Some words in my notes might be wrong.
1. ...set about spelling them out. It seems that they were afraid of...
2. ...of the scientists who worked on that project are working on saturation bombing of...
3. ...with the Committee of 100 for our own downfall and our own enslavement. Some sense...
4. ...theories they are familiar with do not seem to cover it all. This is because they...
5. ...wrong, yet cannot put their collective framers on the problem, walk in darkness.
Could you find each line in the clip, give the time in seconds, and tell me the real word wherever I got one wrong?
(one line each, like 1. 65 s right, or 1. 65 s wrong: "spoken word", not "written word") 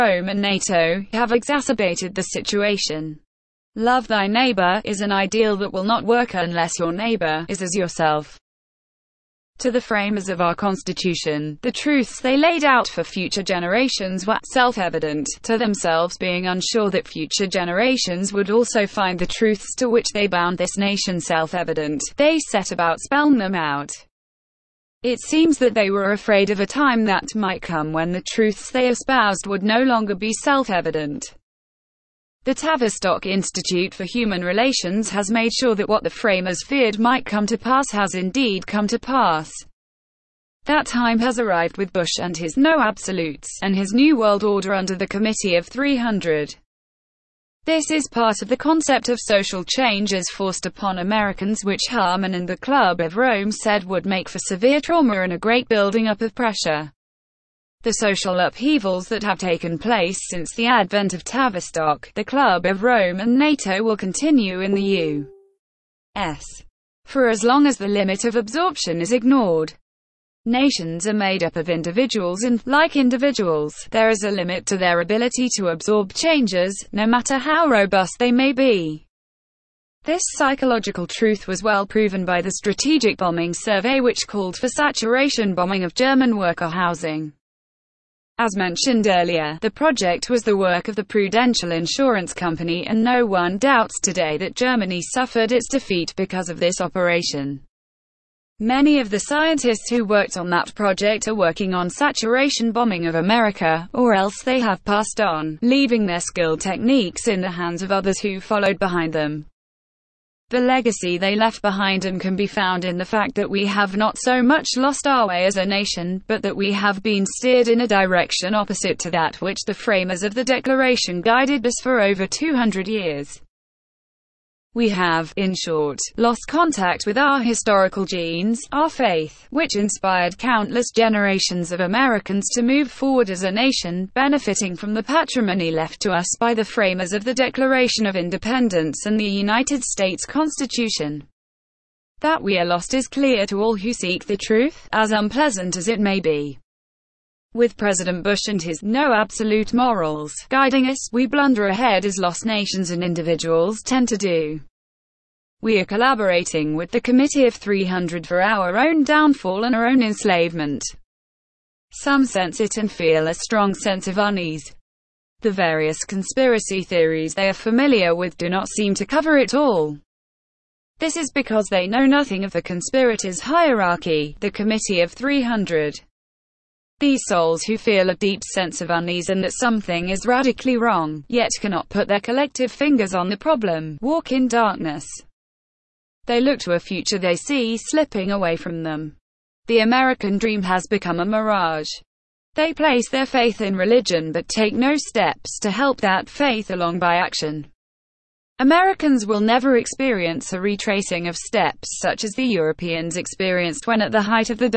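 1. 22 s right
2. 98 s right
3. 156 s wrong: "300", not "100"
4. 166 s right
5. 180 s wrong: "fingers", not "framers".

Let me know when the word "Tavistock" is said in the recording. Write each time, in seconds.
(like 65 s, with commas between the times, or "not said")
32 s, 61 s.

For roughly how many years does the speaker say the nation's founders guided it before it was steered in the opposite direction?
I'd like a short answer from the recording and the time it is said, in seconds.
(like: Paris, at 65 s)
200 years, at 122 s.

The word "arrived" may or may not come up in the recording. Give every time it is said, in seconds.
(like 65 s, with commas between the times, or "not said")
41 s.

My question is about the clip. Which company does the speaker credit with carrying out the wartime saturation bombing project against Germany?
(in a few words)
Prudential Insurance Company.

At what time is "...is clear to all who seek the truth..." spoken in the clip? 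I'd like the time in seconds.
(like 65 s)
142 s.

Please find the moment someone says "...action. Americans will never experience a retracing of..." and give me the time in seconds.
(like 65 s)
197 s.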